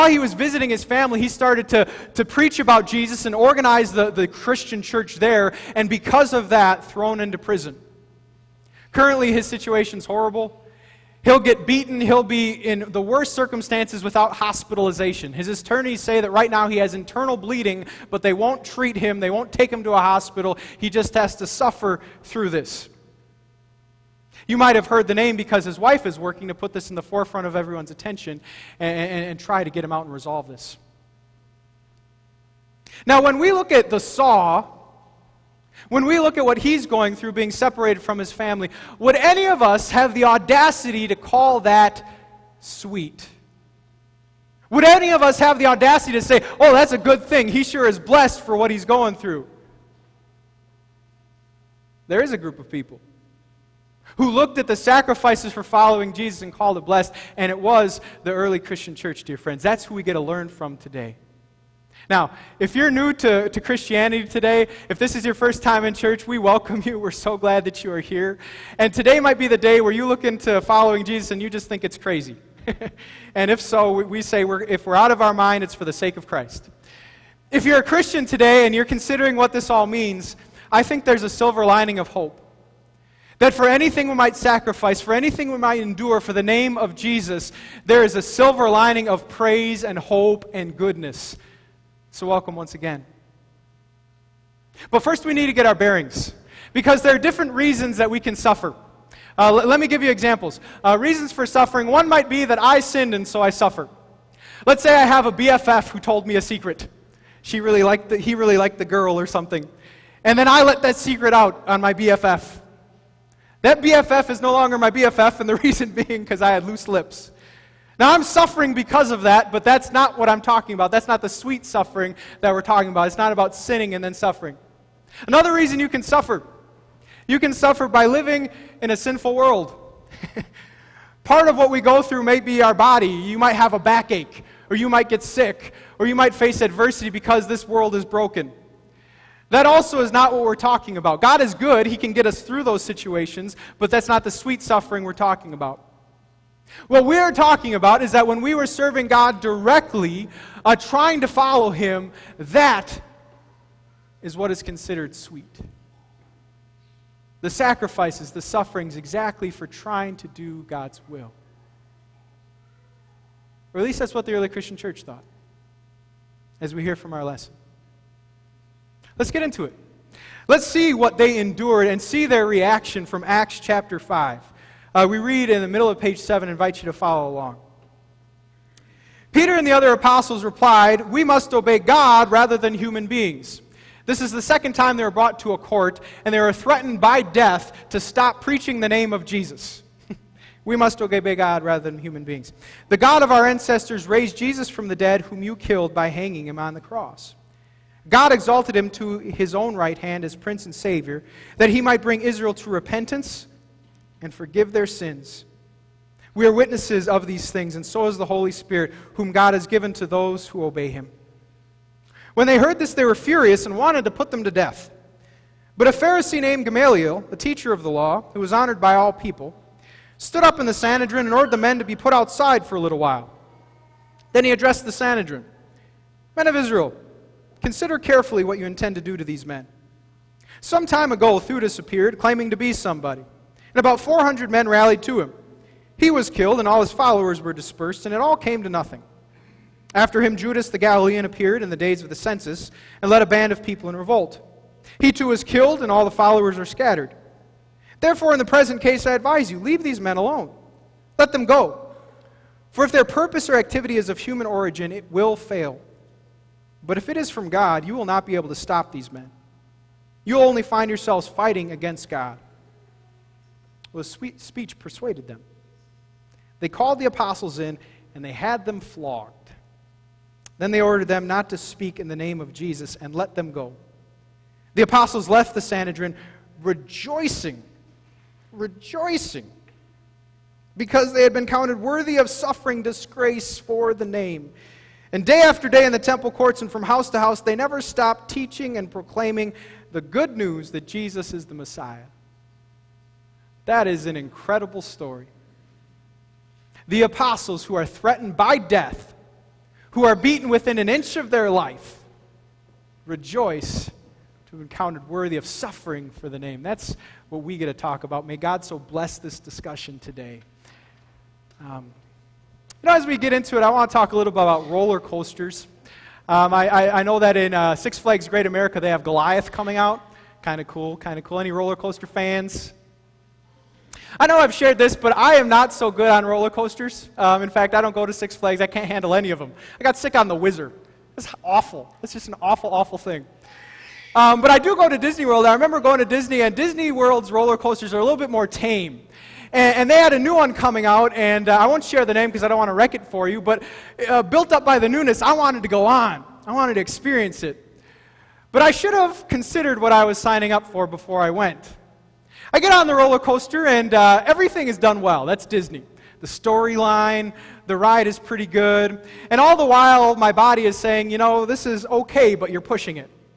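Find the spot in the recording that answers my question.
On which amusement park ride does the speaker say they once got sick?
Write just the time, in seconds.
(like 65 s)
330 s.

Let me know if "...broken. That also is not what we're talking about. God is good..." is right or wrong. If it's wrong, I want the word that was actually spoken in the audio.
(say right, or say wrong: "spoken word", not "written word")
right.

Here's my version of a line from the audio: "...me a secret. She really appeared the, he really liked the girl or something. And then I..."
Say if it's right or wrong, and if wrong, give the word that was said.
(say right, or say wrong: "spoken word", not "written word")
wrong: "liked", not "appeared".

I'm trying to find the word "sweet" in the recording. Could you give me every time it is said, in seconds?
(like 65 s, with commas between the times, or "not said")
42 s, 121 s, 144 s, 155 s.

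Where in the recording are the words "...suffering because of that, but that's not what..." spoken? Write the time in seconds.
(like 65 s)
118 s.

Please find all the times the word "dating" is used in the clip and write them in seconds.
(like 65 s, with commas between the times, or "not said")
not said.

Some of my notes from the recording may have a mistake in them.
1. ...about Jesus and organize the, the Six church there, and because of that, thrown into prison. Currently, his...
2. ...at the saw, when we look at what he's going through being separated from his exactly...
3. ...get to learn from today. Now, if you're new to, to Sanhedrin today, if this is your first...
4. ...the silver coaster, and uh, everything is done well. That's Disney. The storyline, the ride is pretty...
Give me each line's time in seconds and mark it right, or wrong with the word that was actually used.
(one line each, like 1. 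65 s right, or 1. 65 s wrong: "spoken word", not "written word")
1. 2 s wrong: "Christian", not "Six"
2. 33 s wrong: "family", not "exactly"
3. 60 s wrong: "Christianity", not "Sanhedrin"
4. 352 s wrong: "roller", not "silver".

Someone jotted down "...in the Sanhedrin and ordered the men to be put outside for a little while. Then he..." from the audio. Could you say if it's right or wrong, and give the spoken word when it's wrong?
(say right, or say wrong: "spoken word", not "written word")
right.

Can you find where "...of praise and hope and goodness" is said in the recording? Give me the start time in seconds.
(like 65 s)
89 s.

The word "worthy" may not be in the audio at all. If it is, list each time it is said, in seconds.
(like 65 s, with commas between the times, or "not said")
281 s, 305 s.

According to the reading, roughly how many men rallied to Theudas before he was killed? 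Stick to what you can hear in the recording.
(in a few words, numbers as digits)
400.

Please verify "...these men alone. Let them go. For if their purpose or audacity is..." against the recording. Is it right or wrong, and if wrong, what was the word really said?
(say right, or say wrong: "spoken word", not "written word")
wrong: "activity", not "audacity".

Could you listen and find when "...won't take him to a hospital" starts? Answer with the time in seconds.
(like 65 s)
19 s.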